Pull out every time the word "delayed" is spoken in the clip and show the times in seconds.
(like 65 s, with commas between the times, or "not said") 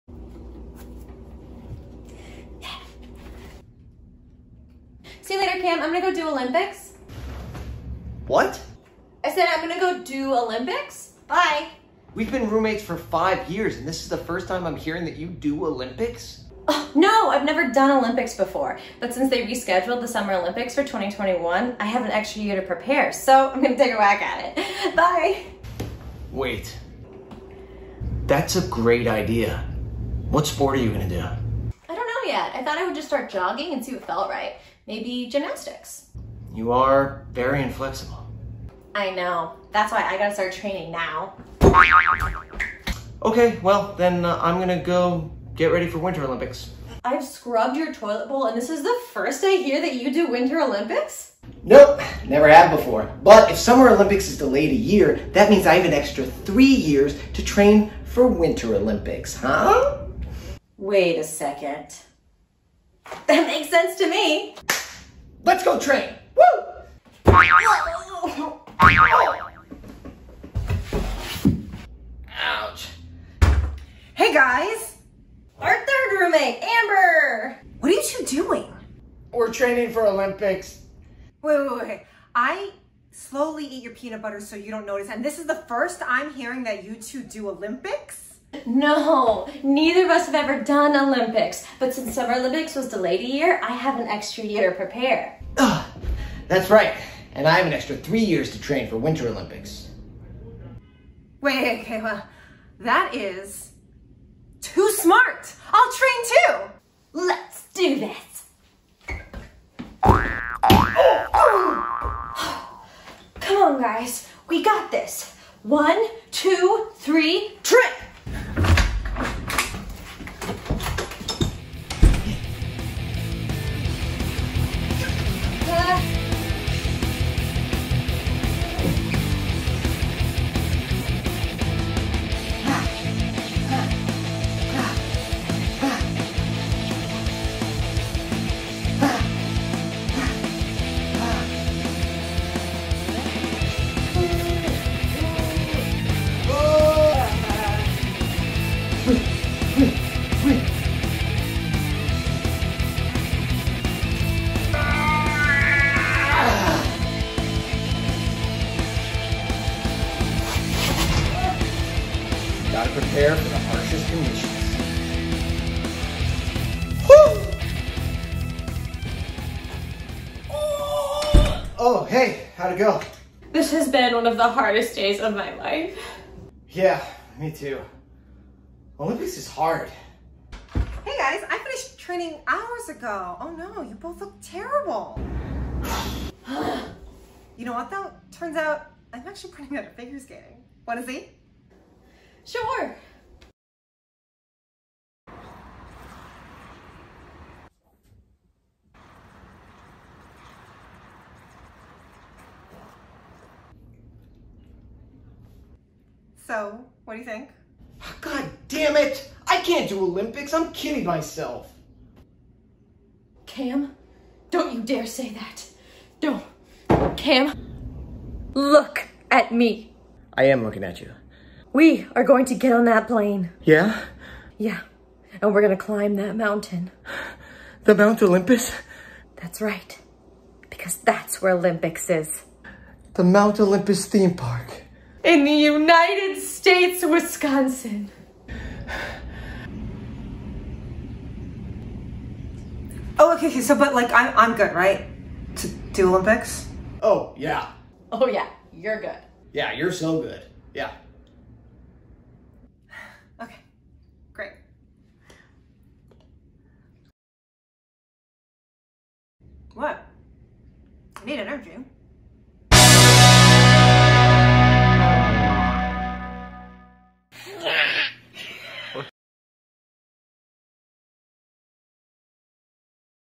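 54 s, 92 s.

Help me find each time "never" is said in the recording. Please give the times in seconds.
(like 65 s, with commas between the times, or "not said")
17 s, 52 s.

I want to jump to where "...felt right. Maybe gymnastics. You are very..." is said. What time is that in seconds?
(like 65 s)
34 s.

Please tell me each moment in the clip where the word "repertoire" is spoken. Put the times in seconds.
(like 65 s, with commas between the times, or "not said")
not said.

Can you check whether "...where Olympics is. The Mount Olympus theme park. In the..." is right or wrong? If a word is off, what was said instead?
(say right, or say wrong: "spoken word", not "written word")
right.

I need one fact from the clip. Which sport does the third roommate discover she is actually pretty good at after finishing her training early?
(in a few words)
Figure skating.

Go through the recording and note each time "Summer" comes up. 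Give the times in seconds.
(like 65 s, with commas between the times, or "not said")
20 s, 53 s, 92 s.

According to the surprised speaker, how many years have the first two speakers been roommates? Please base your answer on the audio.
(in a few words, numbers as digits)
5.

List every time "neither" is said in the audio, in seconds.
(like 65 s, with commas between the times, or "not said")
89 s.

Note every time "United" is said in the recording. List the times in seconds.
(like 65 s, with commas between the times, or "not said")
235 s.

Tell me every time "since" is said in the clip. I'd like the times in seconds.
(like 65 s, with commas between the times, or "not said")
19 s, 91 s.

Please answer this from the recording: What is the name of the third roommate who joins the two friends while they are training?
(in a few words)
Amber.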